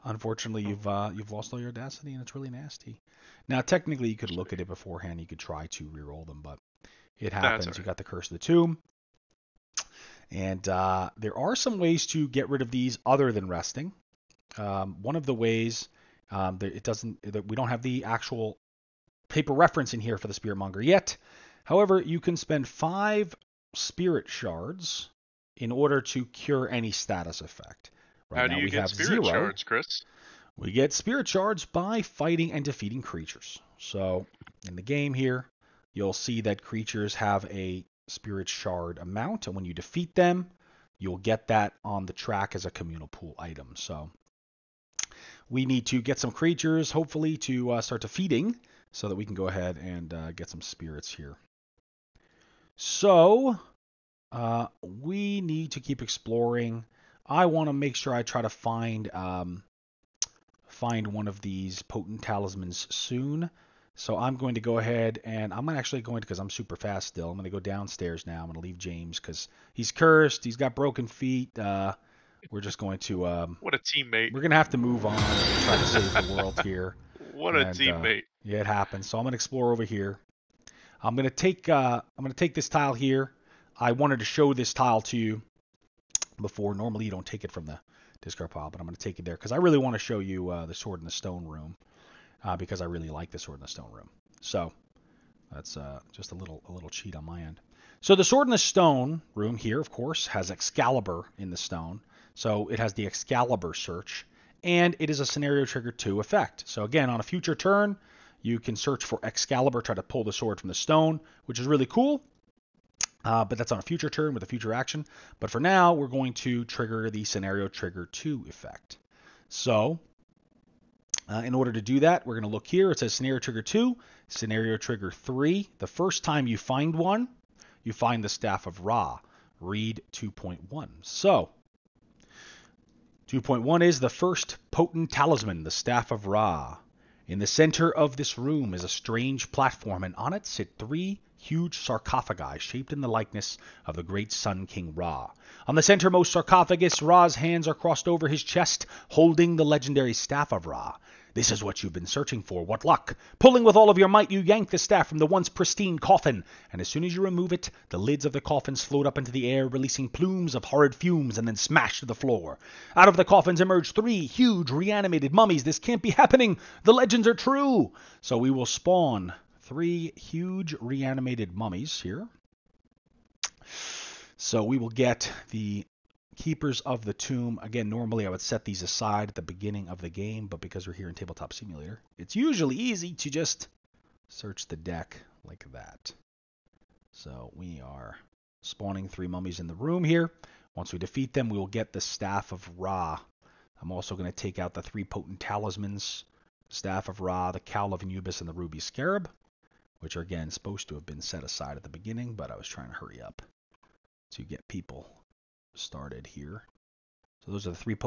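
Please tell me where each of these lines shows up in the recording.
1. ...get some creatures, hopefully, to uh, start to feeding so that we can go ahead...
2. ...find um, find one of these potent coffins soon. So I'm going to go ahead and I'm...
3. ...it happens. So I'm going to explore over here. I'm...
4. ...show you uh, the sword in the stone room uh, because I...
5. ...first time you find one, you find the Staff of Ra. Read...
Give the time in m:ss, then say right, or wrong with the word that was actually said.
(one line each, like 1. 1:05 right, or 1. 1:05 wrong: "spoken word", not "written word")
1. 0:45 right
2. 0:58 wrong: "talismans", not "coffins"
3. 1:18 right
4. 1:29 right
5. 2:05 right.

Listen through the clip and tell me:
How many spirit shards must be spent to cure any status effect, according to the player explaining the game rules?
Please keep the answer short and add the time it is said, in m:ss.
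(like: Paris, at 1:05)
5, at 0:22.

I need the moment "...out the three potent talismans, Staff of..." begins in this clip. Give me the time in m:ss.
3:14.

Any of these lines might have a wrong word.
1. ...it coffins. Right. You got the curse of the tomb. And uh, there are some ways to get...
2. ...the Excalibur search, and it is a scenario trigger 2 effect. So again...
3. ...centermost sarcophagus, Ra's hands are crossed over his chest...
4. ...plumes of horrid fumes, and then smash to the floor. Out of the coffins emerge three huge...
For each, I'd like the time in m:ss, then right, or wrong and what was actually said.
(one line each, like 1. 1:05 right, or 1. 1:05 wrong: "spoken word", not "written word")
1. 0:07 wrong: "happens", not "coffins"
2. 1:42 right
3. 2:25 right
4. 2:40 right.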